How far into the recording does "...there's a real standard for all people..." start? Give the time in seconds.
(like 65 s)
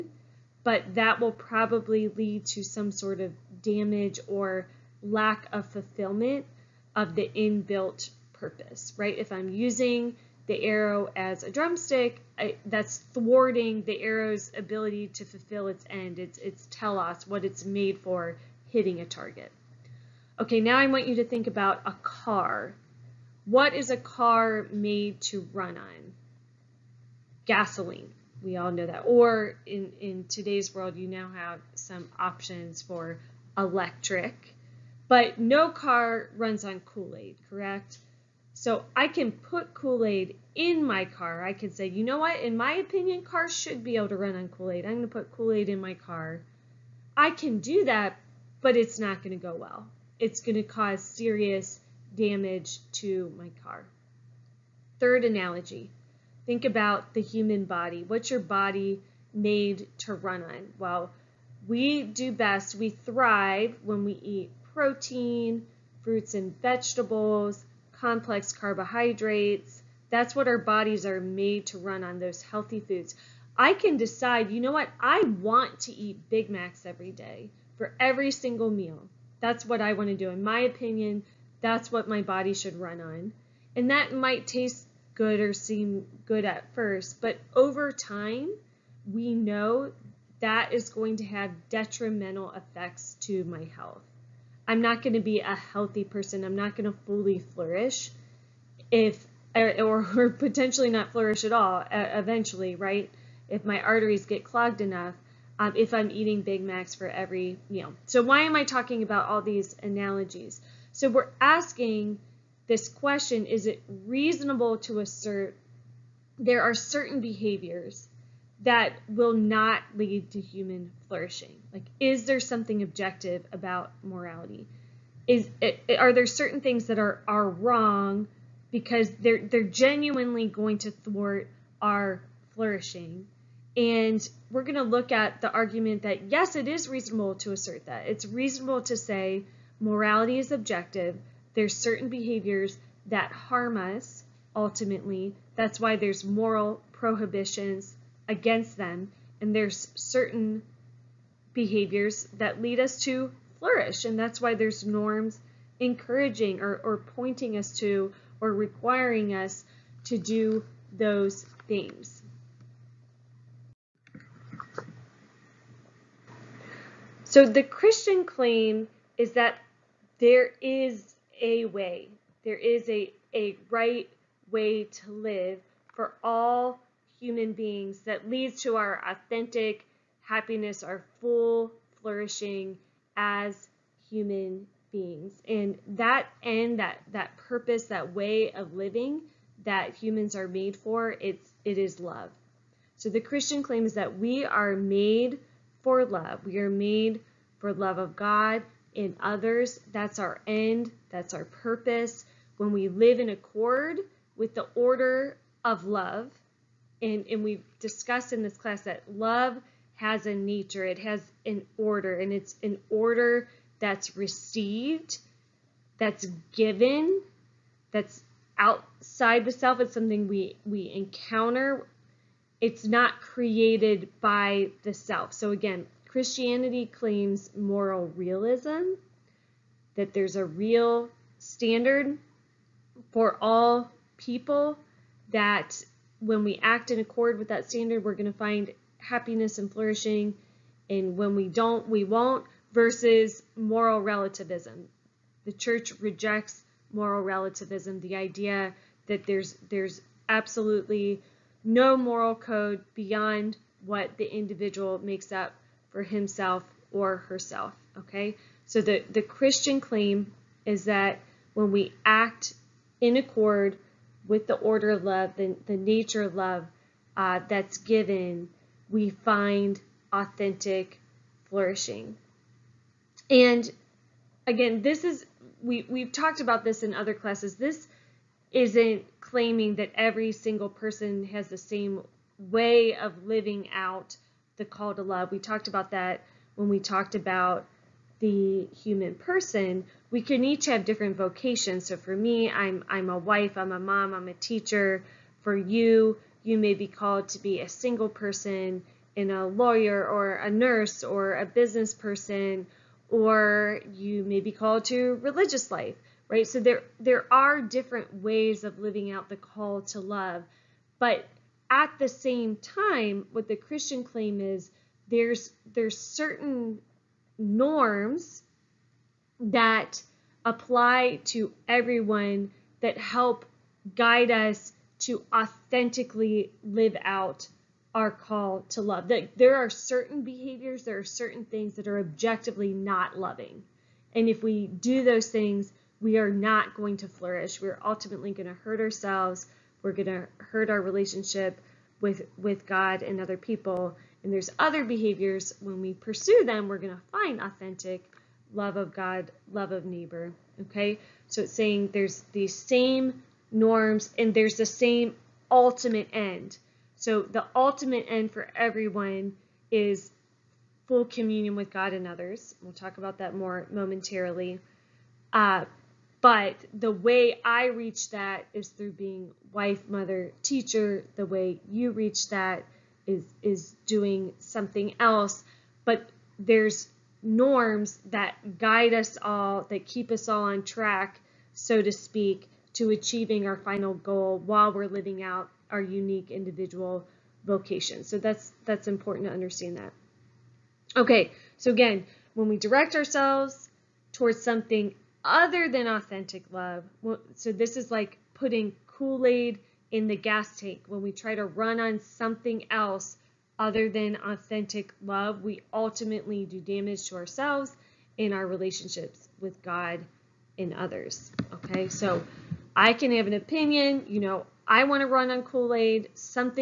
230 s.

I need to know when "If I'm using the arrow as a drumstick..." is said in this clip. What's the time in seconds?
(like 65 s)
9 s.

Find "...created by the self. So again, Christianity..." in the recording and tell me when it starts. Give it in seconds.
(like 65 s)
223 s.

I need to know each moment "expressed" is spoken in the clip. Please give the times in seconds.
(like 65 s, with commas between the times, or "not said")
not said.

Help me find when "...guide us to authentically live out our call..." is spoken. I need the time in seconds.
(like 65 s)
323 s.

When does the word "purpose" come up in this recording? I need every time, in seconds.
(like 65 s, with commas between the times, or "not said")
8 s, 187 s, 201 s.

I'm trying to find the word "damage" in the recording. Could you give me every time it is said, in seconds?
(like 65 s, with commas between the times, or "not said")
3 s, 52 s, 406 s.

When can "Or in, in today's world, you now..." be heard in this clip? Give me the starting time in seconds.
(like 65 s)
29 s.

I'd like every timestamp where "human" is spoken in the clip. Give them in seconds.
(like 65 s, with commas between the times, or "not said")
57 s, 120 s, 177 s, 184 s, 189 s, 288 s.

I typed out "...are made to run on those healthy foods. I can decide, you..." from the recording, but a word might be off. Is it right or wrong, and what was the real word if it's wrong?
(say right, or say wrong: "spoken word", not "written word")
right.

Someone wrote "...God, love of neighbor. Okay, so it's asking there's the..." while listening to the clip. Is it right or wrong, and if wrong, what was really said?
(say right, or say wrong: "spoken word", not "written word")
wrong: "saying", not "asking".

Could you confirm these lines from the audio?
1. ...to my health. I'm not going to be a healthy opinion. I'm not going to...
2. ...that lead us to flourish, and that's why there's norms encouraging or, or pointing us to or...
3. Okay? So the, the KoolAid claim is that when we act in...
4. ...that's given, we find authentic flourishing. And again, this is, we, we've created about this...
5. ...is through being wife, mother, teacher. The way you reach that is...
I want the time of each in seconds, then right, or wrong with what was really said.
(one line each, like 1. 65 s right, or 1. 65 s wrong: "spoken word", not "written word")
1. 93 s wrong: "person", not "opinion"
2. 152 s right
3. 257 s wrong: "Christian", not "KoolAid"
4. 267 s wrong: "talked", not "created"
5. 368 s right.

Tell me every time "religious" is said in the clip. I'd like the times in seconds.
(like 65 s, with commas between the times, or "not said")
305 s.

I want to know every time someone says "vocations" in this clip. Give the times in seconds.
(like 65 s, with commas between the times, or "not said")
291 s, 387 s.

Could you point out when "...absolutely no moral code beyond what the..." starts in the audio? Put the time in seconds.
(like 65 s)
250 s.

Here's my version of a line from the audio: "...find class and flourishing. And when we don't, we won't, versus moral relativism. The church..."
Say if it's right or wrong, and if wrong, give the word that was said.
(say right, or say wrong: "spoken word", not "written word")
wrong: "happiness", not "class".